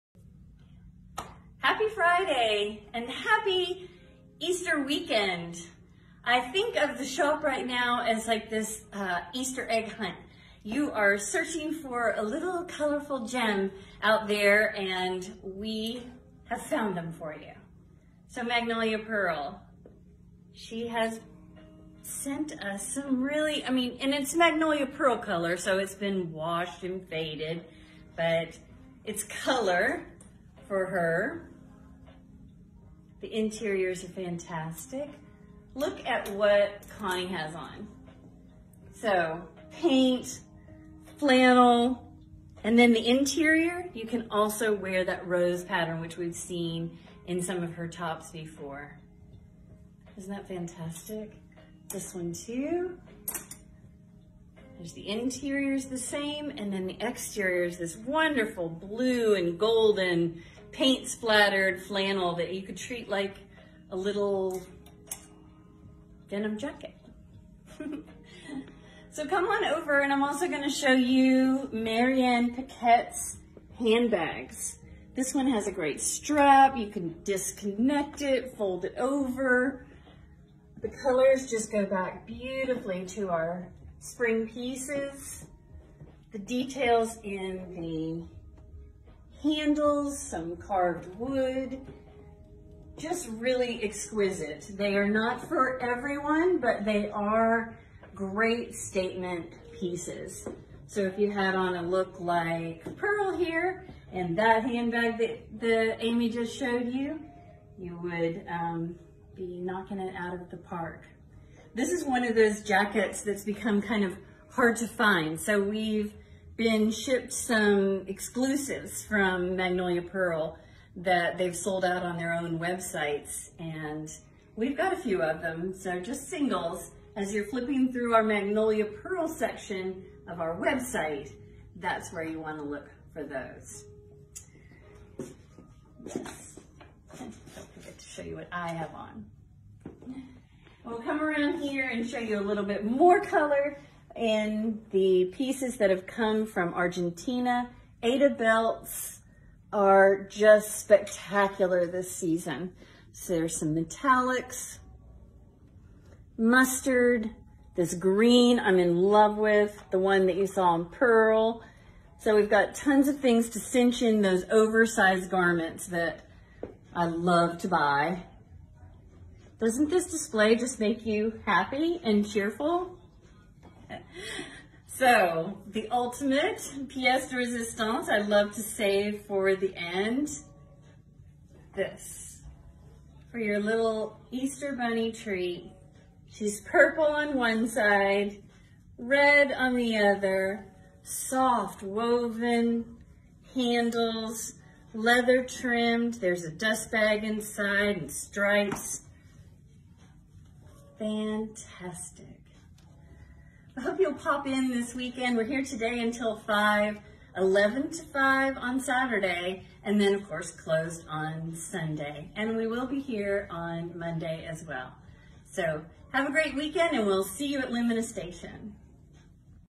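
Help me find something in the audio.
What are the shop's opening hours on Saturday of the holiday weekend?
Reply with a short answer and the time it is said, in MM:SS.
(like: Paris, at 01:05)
11 to 5, at 03:27.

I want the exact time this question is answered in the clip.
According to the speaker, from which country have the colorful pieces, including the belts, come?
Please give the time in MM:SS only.
02:26.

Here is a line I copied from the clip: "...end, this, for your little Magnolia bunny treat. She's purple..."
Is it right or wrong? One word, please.
wrong.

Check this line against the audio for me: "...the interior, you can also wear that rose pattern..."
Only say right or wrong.
right.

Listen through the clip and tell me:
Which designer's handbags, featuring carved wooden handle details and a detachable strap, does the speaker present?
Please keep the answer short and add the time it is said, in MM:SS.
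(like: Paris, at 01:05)
Marian Paquette, at 01:11.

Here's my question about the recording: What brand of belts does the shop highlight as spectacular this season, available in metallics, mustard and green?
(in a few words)
Ada.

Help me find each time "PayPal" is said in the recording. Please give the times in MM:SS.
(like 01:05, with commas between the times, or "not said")
not said.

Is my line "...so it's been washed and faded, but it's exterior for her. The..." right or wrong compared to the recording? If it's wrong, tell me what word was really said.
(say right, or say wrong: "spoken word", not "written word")
wrong: "color", not "exterior".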